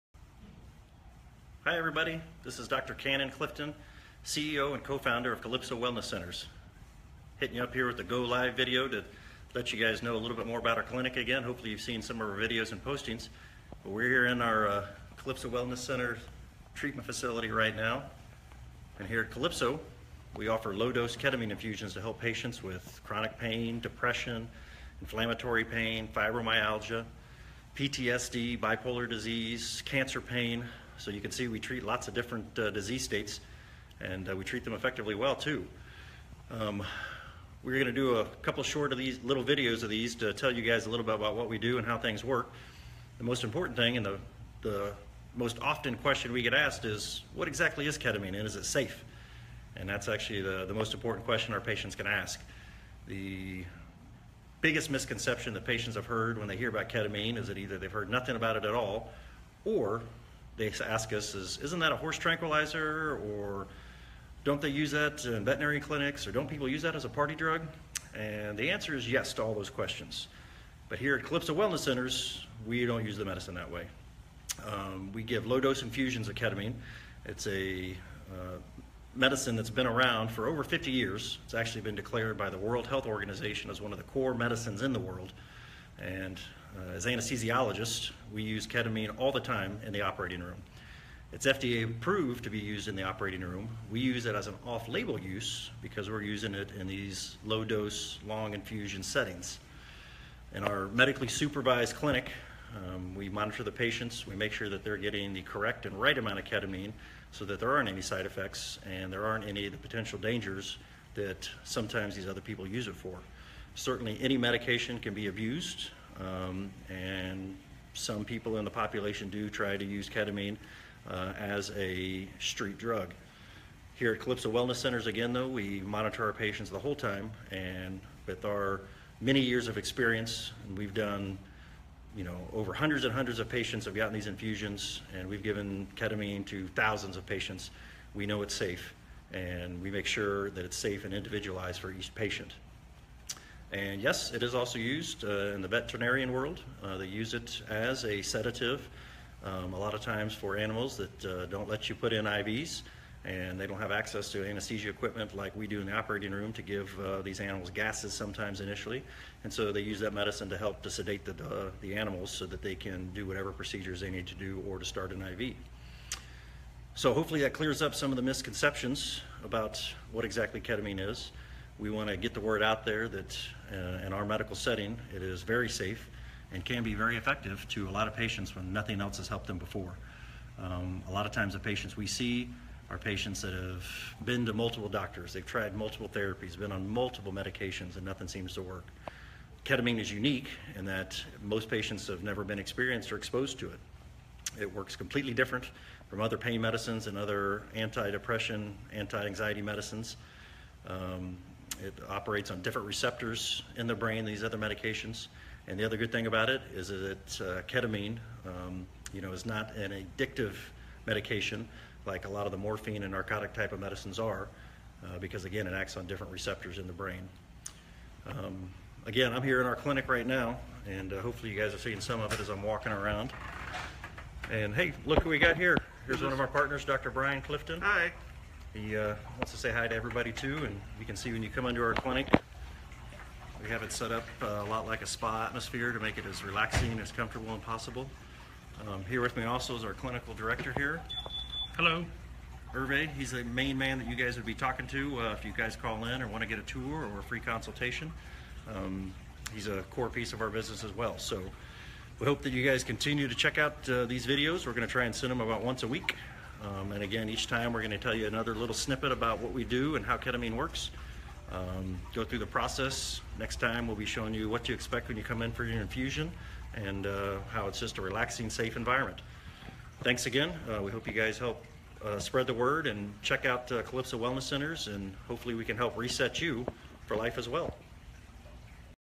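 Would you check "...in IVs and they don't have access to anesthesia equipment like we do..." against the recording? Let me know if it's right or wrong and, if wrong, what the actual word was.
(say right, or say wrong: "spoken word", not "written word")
right.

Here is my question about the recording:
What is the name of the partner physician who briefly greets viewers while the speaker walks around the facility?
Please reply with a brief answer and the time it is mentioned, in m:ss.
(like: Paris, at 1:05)
Dr. Brian Clifton, at 3:46.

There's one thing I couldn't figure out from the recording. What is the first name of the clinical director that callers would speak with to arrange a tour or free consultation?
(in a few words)
Hervé.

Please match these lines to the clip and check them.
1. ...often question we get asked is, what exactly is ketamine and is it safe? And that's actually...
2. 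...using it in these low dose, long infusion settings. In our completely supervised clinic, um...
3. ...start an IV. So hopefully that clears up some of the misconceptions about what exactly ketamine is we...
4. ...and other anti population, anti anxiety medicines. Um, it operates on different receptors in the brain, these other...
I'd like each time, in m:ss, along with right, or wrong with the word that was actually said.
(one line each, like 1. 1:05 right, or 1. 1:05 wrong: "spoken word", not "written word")
1. 0:45 right
2. 1:36 wrong: "medically", not "completely"
3. 2:44 right
4. 3:17 wrong: "depression", not "population".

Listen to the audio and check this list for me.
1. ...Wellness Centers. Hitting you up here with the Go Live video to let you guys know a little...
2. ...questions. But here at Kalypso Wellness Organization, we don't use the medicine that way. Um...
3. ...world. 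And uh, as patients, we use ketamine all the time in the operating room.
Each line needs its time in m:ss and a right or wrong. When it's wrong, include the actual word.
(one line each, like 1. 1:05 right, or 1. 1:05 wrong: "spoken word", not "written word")
1. 0:05 right
2. 1:09 wrong: "Centers", not "Organization"
3. 1:24 wrong: "anesthesiologists", not "patients".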